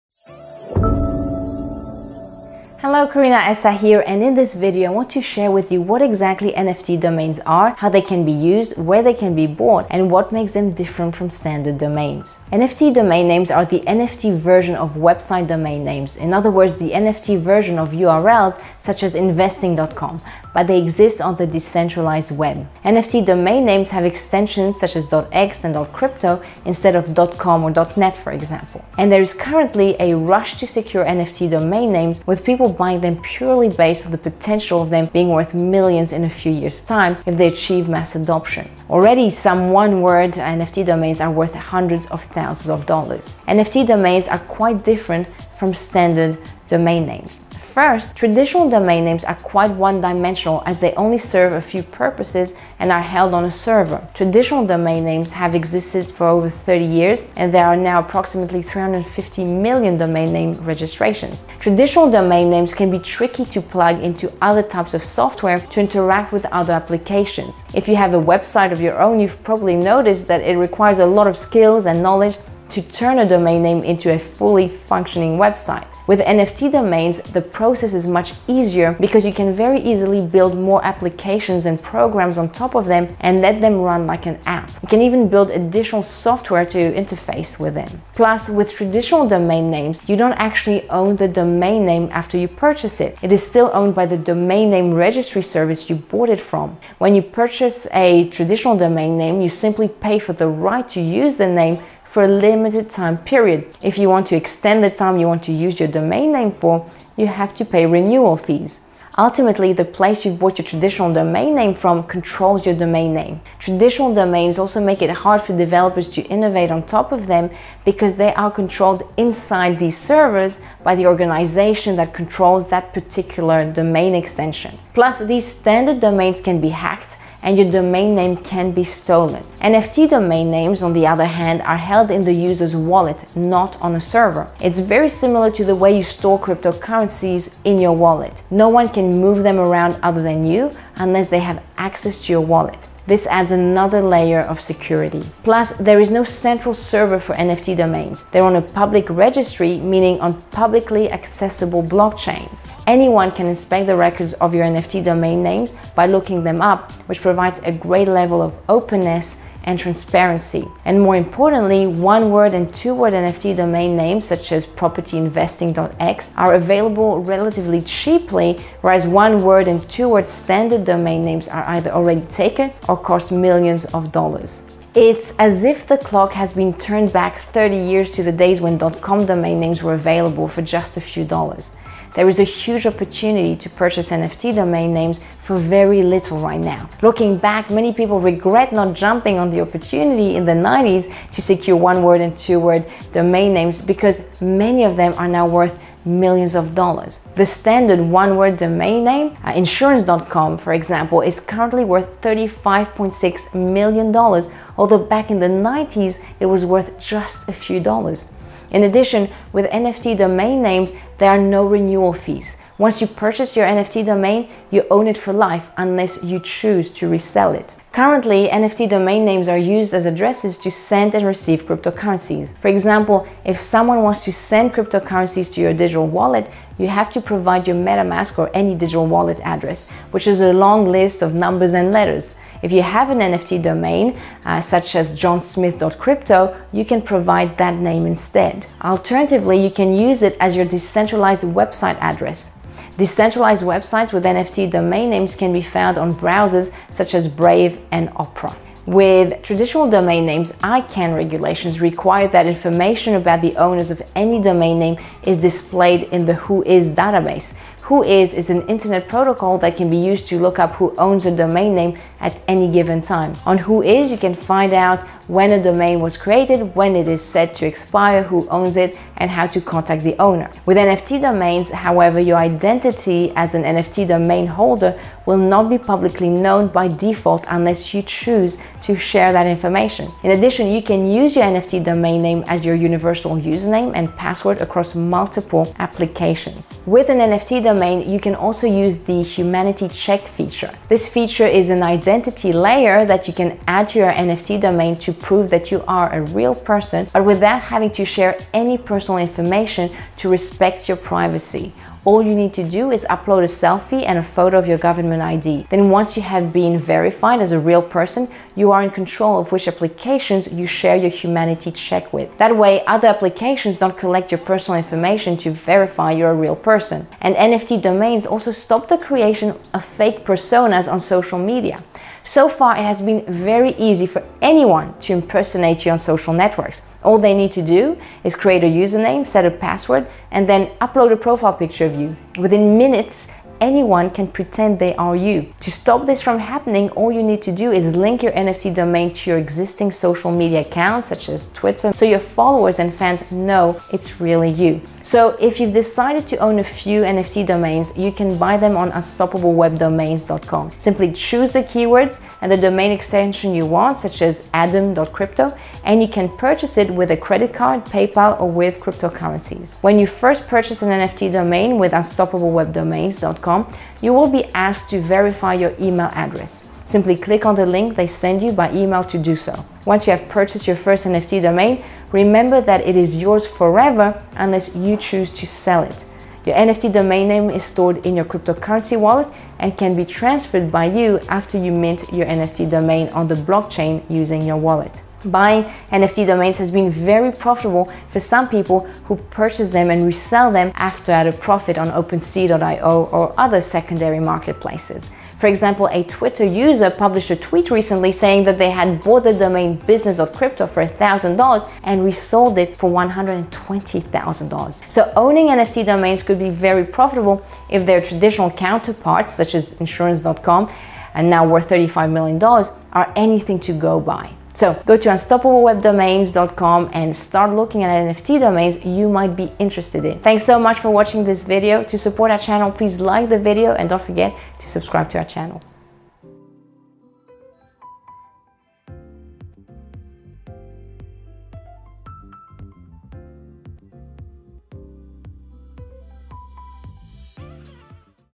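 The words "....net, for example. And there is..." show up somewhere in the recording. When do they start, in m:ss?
0:27.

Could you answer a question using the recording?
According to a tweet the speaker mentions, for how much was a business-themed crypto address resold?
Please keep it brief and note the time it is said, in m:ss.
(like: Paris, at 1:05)
$120,000, at 6:42.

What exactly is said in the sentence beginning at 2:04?
Plus, these standard domains can be hacked and your domain name can be stolen.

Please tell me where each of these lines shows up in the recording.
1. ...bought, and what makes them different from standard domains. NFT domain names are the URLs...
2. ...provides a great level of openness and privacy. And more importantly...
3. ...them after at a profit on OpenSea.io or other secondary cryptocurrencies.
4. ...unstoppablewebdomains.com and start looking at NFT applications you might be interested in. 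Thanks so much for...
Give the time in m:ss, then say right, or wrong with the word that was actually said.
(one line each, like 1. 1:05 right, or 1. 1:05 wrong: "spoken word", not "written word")
1. 0:09 wrong: "NFT", not "URLs"
2. 2:37 wrong: "transparency", not "privacy"
3. 6:30 wrong: "marketplaces", not "cryptocurrencies"
4. 6:55 wrong: "domains", not "applications".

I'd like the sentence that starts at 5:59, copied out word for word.
When you first purchase an NFT domain with unstoppablewebdomains.com, gmail.com, you will be asked to verify your email address.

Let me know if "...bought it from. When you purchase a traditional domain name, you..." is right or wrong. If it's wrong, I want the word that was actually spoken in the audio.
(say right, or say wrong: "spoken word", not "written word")
right.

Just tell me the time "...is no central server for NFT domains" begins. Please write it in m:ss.
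2:25.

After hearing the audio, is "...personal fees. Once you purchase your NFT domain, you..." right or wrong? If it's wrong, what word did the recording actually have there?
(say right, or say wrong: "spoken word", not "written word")
wrong: "renewal", not "personal".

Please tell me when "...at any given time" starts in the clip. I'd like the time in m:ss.
4:22.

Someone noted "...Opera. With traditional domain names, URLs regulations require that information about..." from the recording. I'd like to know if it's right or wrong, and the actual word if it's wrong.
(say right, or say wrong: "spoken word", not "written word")
wrong: "ICANN", not "URLs".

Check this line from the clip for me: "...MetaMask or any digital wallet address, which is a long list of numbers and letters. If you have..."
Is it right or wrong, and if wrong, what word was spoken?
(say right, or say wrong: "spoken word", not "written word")
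right.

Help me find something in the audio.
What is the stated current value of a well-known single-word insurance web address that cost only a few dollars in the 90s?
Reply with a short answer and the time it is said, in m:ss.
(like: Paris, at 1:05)
$35.6 million, at 3:22.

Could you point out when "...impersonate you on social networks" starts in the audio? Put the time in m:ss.
5:25.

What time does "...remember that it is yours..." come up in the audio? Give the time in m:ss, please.
6:12.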